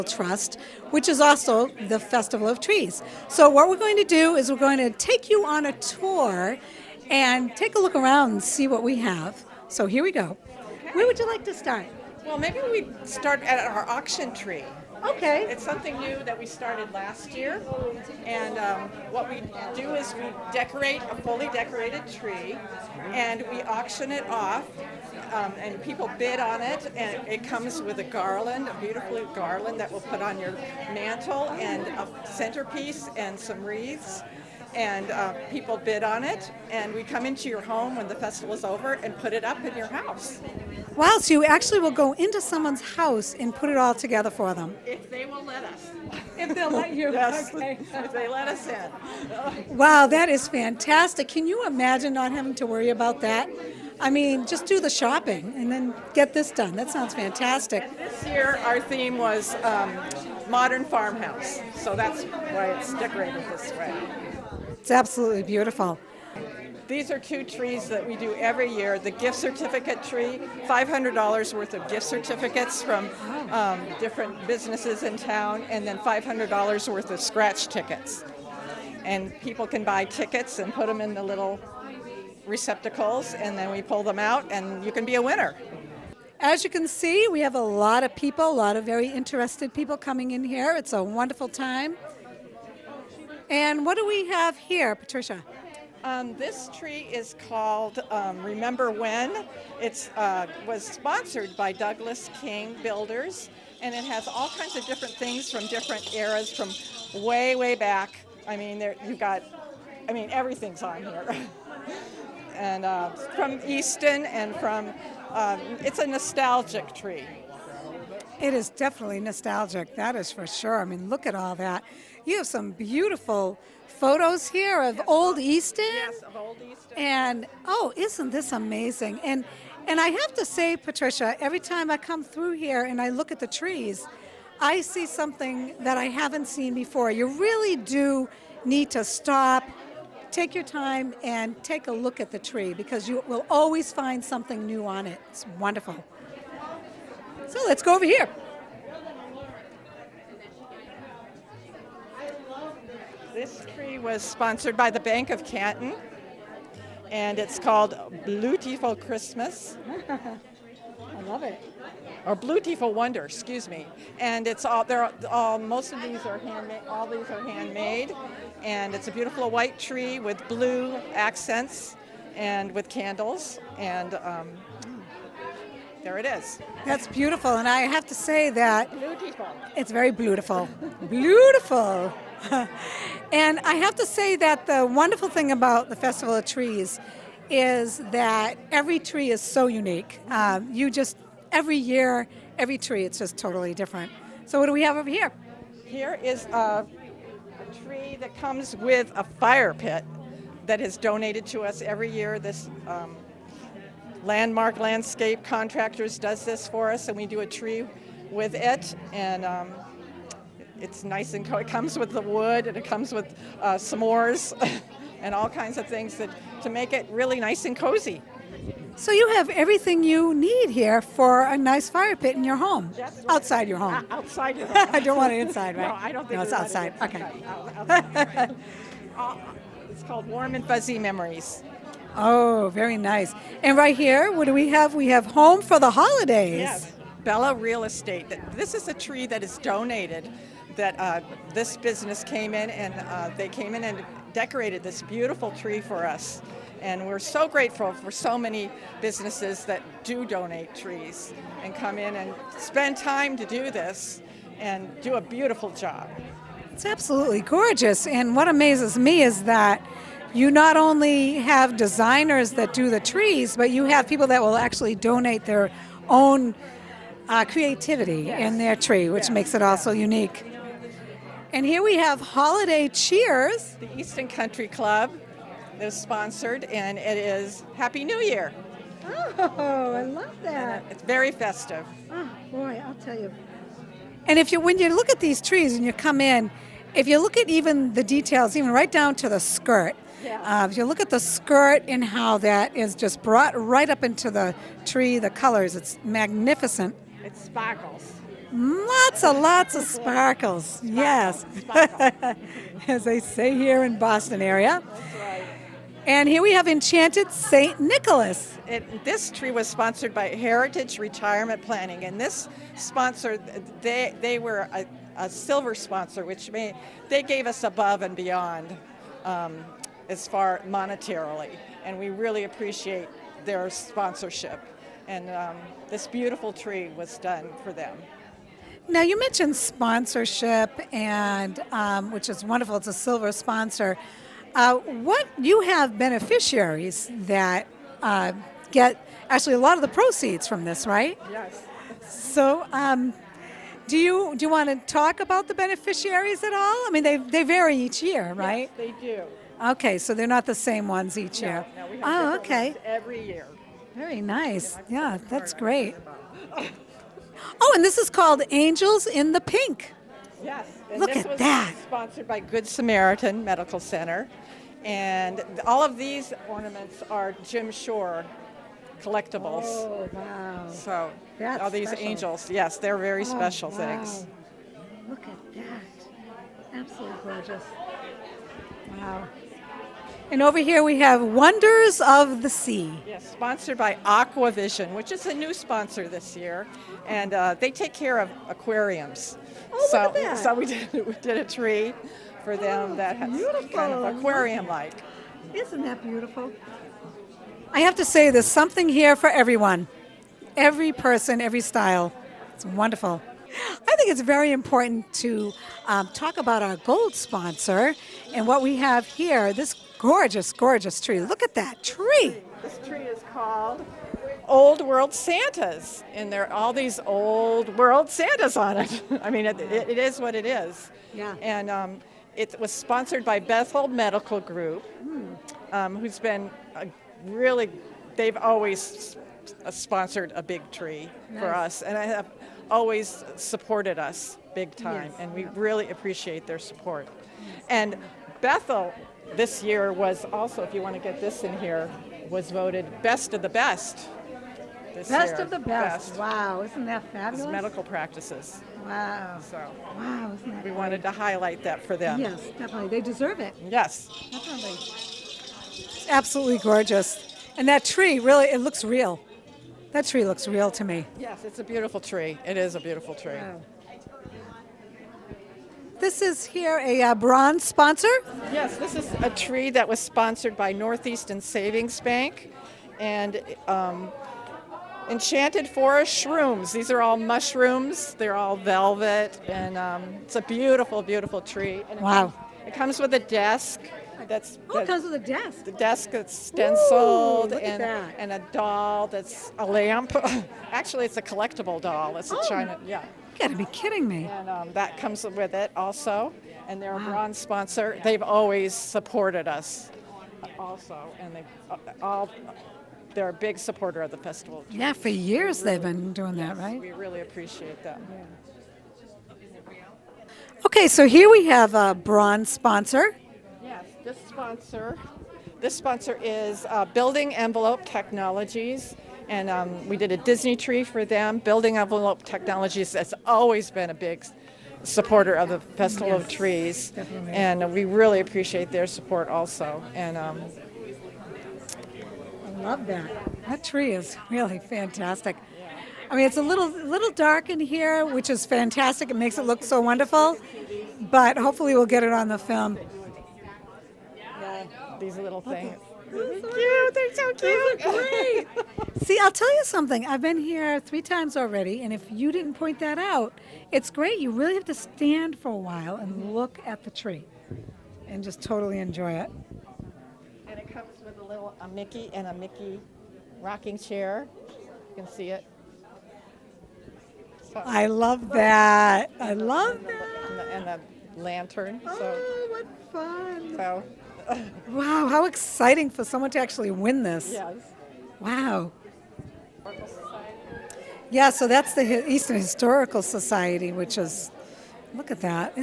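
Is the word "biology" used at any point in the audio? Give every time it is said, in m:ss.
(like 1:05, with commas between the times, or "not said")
not said.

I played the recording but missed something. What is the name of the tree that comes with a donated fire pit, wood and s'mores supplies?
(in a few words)
Warm and Fuzzy Memories.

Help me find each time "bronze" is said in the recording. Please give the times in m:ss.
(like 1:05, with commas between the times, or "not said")
7:47, 8:17, 8:31.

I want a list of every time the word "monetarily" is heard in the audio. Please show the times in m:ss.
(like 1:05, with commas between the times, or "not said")
5:20.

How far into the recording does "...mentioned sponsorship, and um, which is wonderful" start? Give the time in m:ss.
5:29.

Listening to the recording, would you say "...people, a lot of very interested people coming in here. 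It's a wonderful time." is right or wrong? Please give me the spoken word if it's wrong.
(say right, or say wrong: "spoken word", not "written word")
right.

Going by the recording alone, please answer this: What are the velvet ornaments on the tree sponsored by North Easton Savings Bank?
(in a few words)
mushrooms.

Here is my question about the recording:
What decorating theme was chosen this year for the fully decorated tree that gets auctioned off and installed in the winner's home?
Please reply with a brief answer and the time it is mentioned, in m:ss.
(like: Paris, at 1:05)
modern farmhouse, at 1:00.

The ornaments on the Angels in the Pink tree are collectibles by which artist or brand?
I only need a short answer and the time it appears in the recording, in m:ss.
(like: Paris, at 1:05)
Jim Shore, at 6:07.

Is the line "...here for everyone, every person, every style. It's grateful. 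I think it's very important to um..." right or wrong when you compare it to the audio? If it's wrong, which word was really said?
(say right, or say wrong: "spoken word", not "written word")
wrong: "wonderful", not "grateful".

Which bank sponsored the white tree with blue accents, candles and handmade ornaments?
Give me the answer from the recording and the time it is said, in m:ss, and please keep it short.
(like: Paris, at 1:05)
Bank of Canton, at 2:34.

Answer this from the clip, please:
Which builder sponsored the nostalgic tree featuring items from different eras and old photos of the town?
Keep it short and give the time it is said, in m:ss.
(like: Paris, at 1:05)
Douglas King Builders, at 1:41.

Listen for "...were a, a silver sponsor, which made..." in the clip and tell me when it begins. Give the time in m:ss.
5:14.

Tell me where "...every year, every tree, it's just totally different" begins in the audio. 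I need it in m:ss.
3:11.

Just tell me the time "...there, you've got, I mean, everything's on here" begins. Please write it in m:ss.
1:48.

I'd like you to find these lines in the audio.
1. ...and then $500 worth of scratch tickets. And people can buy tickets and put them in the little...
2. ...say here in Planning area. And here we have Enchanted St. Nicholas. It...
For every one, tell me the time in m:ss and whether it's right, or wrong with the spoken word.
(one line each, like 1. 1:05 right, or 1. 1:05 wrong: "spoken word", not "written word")
1. 1:15 right
2. 5:03 wrong: "Boston", not "Planning".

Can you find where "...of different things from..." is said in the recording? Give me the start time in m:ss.
1:44.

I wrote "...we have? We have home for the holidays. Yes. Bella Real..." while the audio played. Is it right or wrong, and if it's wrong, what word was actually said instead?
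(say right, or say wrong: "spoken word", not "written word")
right.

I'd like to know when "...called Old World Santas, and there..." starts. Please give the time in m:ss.
6:53.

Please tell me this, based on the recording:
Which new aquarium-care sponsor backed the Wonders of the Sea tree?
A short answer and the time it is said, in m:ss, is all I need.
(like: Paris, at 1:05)
Aquavision, at 6:24.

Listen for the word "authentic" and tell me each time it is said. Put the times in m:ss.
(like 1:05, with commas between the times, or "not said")
not said.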